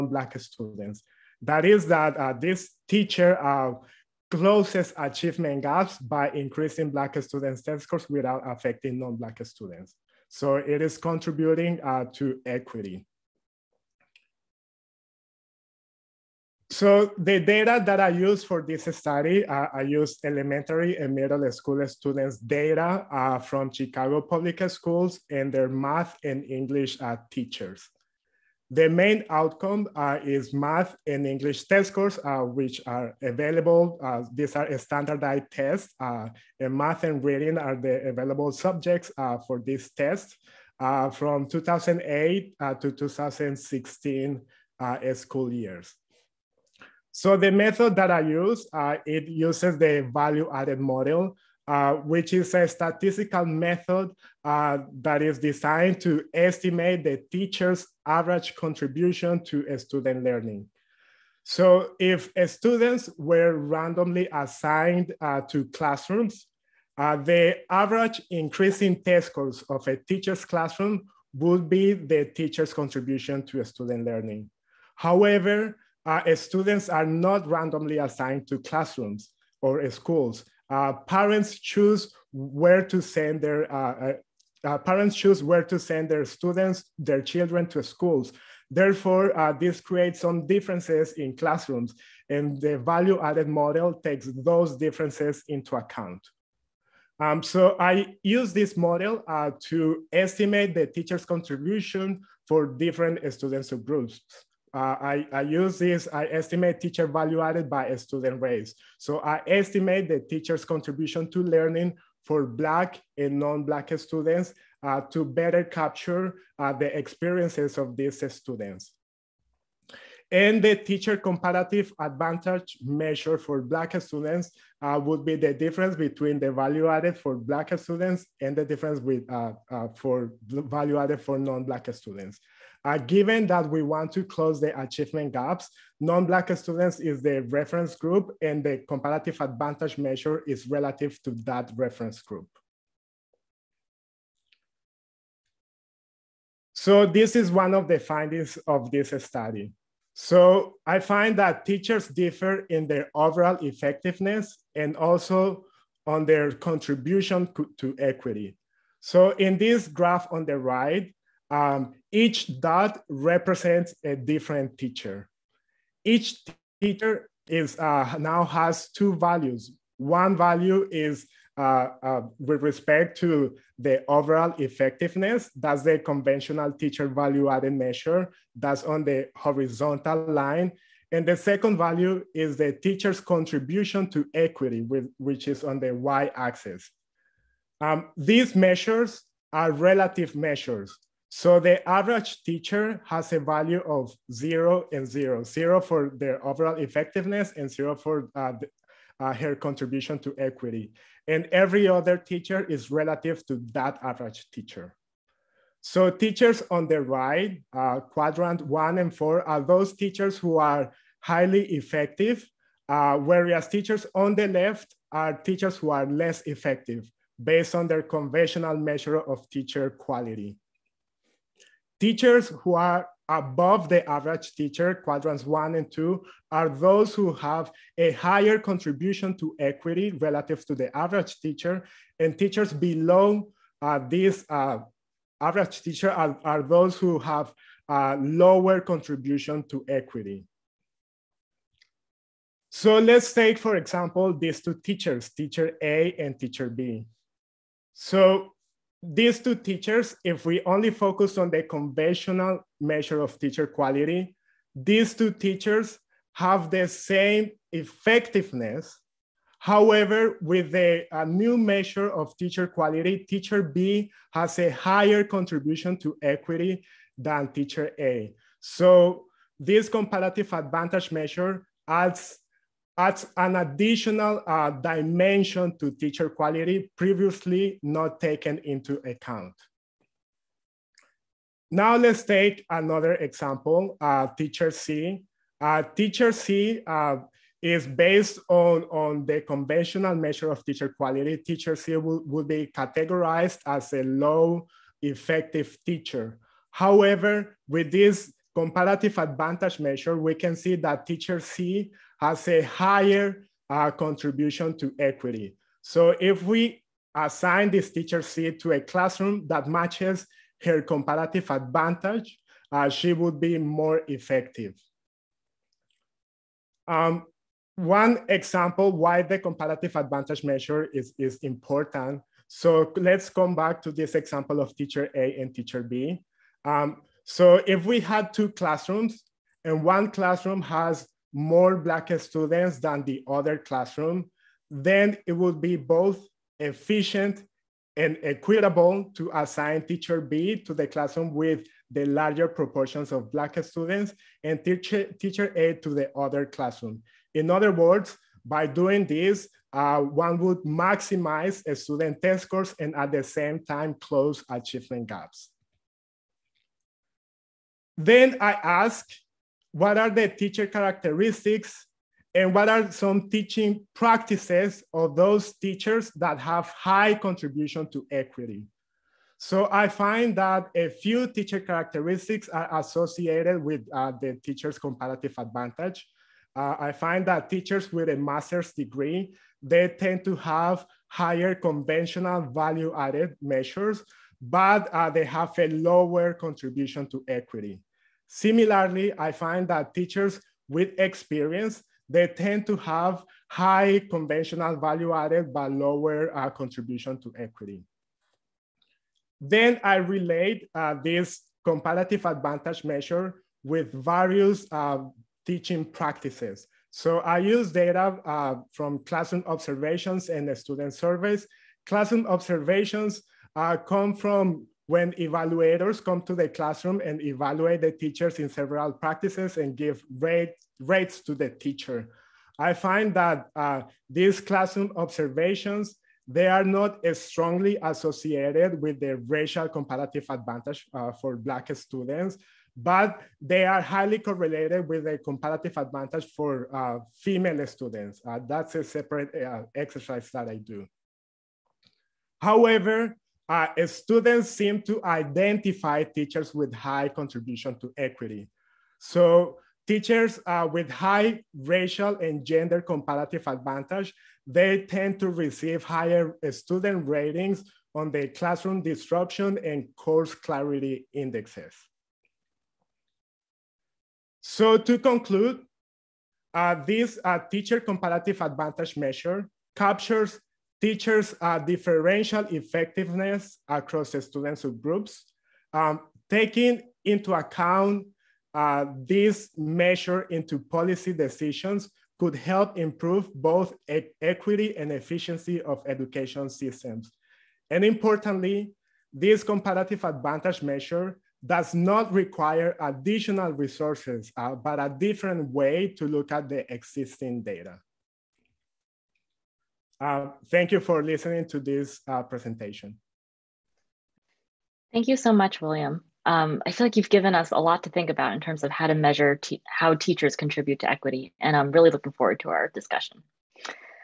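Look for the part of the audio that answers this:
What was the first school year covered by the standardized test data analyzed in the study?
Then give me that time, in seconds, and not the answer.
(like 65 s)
41 s.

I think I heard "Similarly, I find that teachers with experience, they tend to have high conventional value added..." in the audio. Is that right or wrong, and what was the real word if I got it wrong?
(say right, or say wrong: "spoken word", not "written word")
right.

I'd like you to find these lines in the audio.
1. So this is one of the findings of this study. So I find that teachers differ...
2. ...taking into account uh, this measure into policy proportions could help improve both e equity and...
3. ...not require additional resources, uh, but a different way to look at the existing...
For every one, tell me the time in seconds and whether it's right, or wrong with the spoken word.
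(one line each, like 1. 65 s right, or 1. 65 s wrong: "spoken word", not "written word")
1. 146 s right
2. 476 s wrong: "decisions", not "proportions"
3. 491 s right.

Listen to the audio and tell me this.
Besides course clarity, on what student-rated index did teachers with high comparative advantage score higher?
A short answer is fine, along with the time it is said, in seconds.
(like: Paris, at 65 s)
classroom disruption, at 458 s.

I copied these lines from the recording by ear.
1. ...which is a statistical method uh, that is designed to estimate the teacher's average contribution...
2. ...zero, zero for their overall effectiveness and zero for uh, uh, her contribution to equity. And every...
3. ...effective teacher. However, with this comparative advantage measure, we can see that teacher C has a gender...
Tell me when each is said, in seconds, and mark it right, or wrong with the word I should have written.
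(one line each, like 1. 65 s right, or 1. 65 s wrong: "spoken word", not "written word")
1. 51 s right
2. 195 s right
3. 295 s wrong: "higher", not "gender".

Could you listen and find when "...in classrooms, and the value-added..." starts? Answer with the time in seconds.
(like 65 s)
91 s.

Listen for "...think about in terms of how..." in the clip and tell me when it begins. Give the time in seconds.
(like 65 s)
507 s.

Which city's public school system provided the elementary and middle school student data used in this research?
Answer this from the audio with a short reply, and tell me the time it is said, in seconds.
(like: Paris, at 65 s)
Chicago, at 23 s.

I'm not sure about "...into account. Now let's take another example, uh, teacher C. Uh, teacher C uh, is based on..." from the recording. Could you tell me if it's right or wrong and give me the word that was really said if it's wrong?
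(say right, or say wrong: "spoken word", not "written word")
right.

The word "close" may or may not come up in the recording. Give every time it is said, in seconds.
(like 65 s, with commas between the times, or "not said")
4 s, 134 s, 353 s.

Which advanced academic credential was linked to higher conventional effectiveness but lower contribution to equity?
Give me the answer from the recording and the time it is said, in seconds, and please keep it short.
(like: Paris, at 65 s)
master's degree, at 378 s.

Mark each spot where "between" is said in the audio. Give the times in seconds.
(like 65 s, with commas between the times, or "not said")
125 s.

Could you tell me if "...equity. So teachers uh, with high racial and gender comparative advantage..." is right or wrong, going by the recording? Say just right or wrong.
right.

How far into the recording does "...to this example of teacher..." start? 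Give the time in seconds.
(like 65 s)
323 s.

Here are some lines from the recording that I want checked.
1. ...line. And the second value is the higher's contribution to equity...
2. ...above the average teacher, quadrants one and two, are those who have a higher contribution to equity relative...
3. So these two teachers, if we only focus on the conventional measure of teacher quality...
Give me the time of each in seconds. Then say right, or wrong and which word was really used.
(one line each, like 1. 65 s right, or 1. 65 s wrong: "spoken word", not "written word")
1. 180 s wrong: "teacher", not "higher"
2. 223 s right
3. 247 s right.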